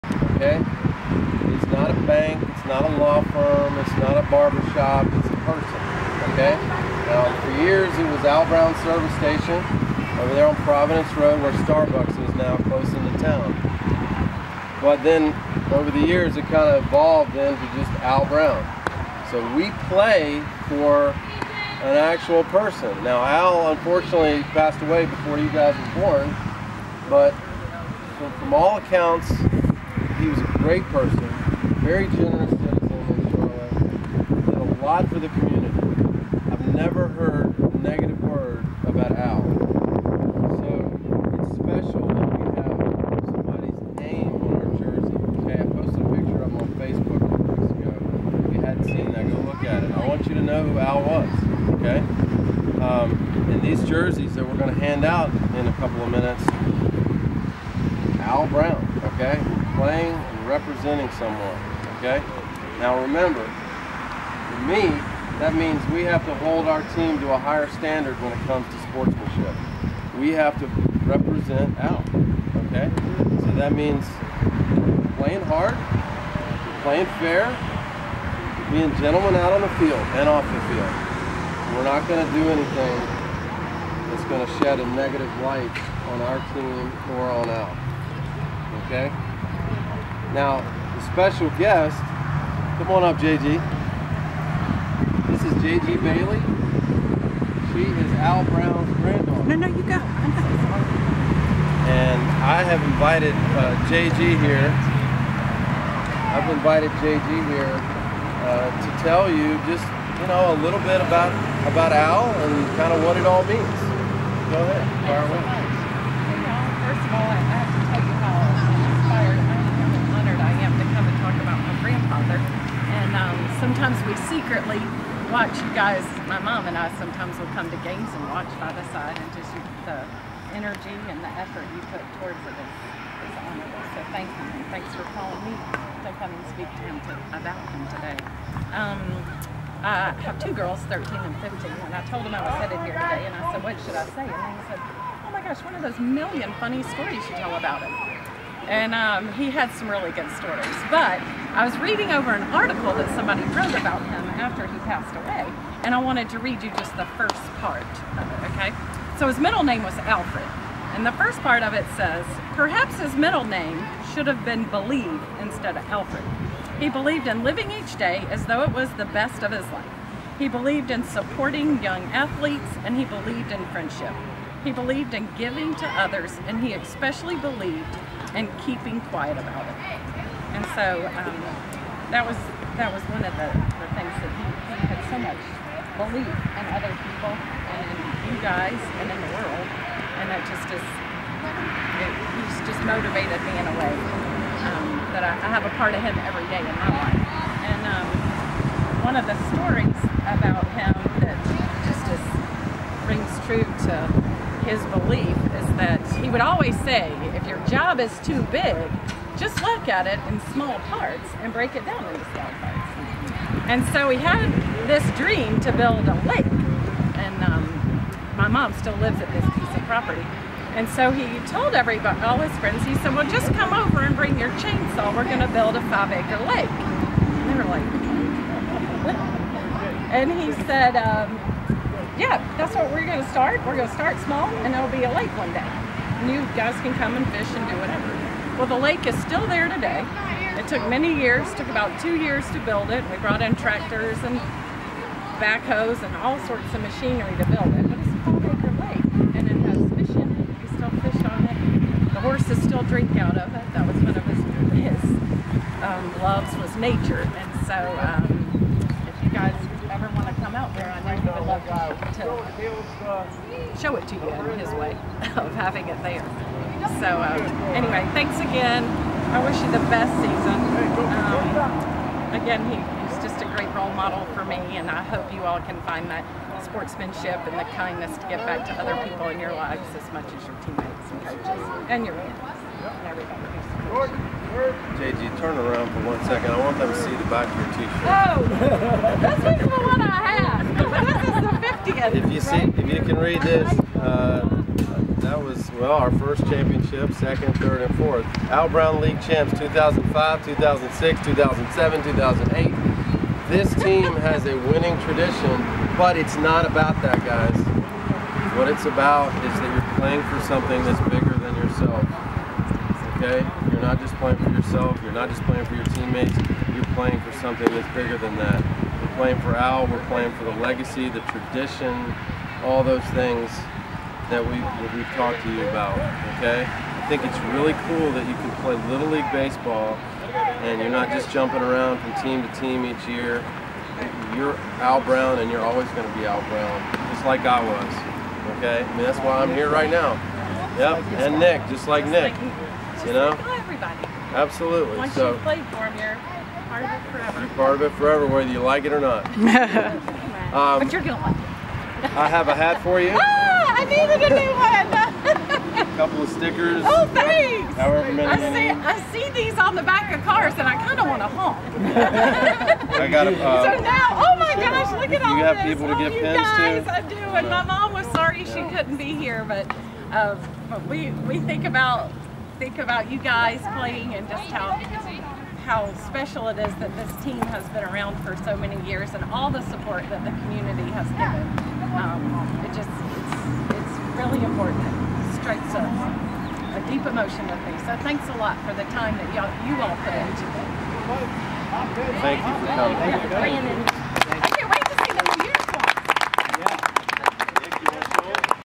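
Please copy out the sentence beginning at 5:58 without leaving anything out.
I see, I see these on the back of cars, and I kind of want to honk.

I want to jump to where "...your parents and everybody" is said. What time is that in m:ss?
4:42.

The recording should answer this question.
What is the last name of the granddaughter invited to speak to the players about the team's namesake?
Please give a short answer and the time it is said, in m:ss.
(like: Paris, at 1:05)
Bailey, at 1:35.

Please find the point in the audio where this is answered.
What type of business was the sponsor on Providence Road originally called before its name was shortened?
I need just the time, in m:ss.
0:08.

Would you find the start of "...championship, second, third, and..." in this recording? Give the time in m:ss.
4:56.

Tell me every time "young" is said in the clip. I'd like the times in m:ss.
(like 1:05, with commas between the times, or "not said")
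2:51.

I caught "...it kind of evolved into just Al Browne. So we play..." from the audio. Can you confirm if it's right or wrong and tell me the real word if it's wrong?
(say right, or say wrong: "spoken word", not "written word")
right.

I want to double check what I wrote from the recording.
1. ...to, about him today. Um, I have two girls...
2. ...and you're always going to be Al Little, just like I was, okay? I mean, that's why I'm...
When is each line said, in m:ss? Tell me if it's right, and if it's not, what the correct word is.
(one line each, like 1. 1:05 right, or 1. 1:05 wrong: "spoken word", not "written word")
1. 2:17 right
2. 5:35 wrong: "Browne", not "Little".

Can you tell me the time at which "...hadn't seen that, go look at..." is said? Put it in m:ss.
0:48.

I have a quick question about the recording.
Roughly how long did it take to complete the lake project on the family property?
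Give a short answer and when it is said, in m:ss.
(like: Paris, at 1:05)
2 years, at 4:01.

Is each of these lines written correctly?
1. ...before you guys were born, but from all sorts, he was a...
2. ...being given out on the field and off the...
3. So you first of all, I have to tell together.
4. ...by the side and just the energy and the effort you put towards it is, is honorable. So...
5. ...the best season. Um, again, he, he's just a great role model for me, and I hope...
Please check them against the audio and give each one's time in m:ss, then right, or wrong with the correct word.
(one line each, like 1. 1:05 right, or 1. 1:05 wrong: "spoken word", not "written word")
1. 0:25 wrong: "accounts", not "sorts"
2. 1:18 wrong: "gentlemen", not "given"
3. 1:55 right
4. 2:08 right
5. 4:29 right.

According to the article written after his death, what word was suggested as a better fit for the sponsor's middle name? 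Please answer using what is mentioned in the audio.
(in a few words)
Believe.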